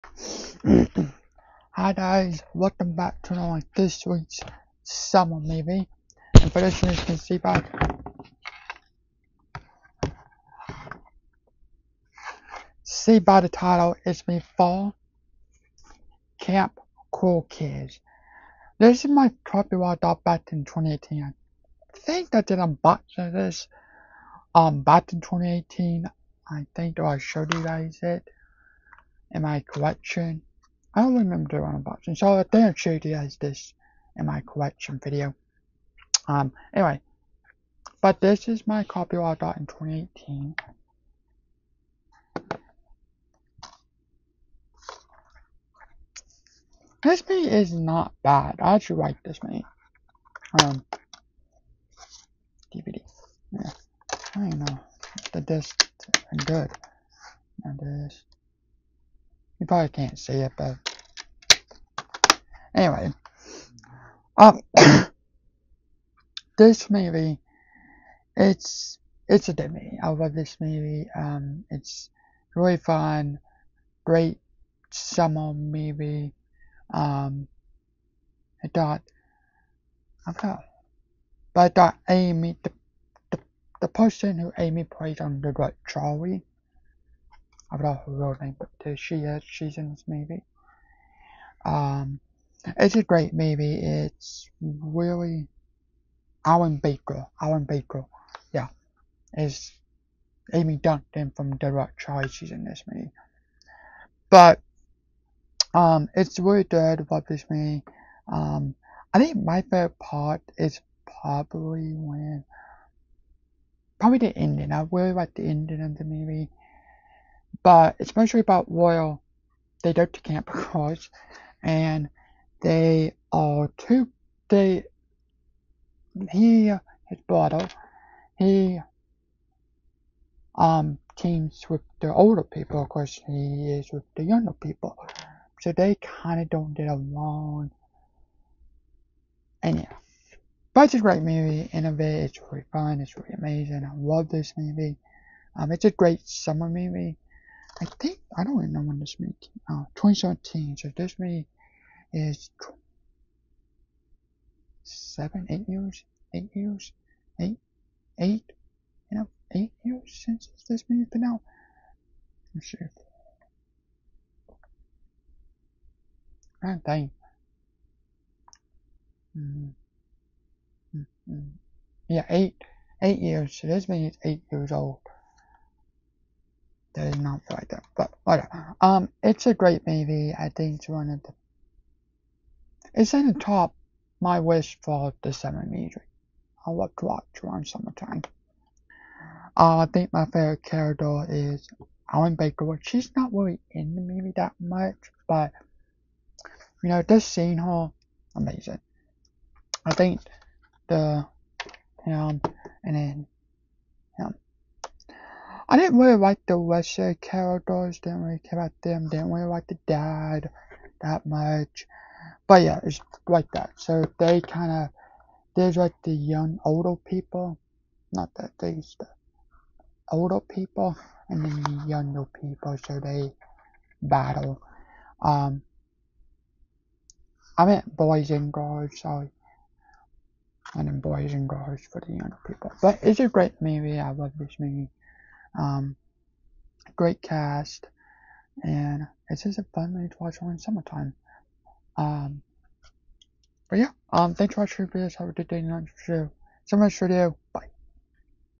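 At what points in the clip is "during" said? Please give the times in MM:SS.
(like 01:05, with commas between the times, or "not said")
04:00.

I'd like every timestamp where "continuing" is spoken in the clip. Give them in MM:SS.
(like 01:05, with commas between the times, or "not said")
not said.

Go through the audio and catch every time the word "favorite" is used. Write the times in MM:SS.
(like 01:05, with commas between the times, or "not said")
01:49, 03:10.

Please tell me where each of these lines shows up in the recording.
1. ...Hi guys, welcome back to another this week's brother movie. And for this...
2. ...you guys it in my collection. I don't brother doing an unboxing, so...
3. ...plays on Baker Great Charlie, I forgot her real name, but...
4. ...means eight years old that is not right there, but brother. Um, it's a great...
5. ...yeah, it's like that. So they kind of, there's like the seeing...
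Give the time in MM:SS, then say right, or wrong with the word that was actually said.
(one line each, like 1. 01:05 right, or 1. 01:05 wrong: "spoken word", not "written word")
1. 00:01 wrong: "summer", not "brother"
2. 00:27 wrong: "remember", not "brother"
3. 01:24 wrong: "The", not "Baker"
4. 02:53 wrong: "whatever", not "brother"
5. 03:32 wrong: "young", not "seeing".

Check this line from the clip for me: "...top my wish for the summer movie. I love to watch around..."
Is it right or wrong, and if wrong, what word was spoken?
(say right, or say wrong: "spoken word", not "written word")
right.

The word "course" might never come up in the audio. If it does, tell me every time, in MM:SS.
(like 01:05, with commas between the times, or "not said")
02:12.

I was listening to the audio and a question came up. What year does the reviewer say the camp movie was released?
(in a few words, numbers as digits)
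2017.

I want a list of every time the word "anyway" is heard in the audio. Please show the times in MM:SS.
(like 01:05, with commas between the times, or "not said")
00:36, 01:02.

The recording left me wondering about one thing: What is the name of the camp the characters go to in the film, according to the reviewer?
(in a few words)
Camp Cross.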